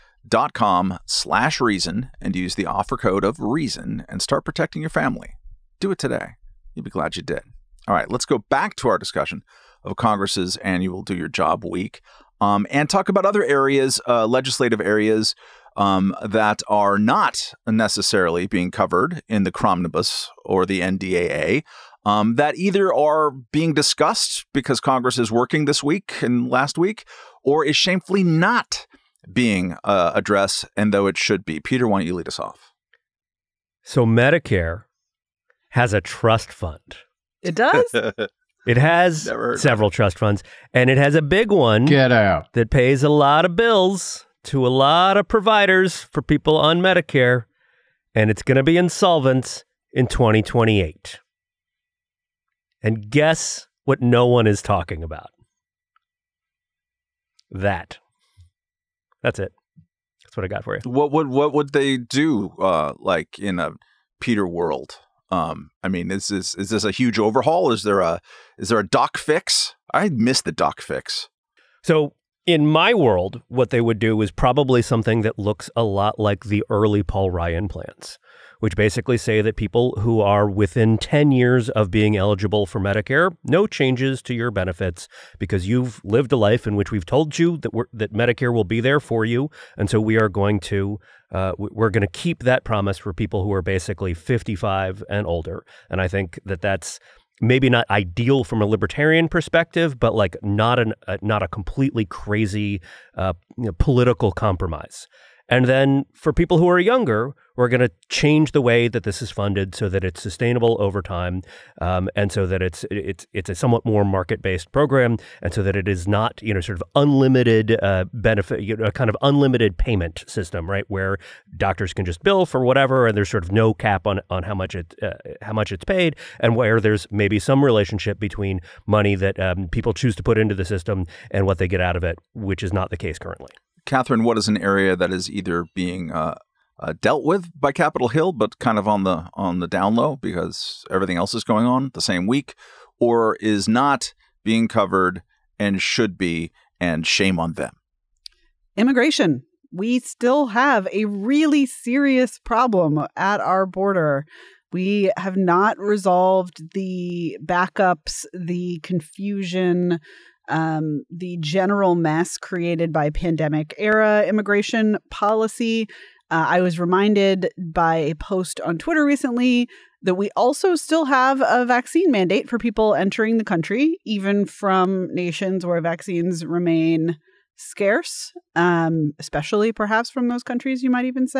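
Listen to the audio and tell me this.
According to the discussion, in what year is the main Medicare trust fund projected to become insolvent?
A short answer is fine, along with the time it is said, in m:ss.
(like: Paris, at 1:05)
2028, at 0:50.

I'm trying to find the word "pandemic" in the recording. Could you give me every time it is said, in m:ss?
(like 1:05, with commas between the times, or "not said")
2:43.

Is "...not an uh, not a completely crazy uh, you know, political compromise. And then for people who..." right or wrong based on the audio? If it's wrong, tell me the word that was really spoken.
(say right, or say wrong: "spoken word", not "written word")
right.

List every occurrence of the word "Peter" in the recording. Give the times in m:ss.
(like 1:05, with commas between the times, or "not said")
0:31, 1:04.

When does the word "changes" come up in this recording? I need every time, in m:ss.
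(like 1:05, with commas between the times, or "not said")
1:23, 1:48.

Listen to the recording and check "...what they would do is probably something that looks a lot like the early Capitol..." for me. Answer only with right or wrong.
wrong.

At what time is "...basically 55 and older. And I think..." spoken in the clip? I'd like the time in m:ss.
1:33.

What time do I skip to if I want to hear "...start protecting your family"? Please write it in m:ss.
0:04.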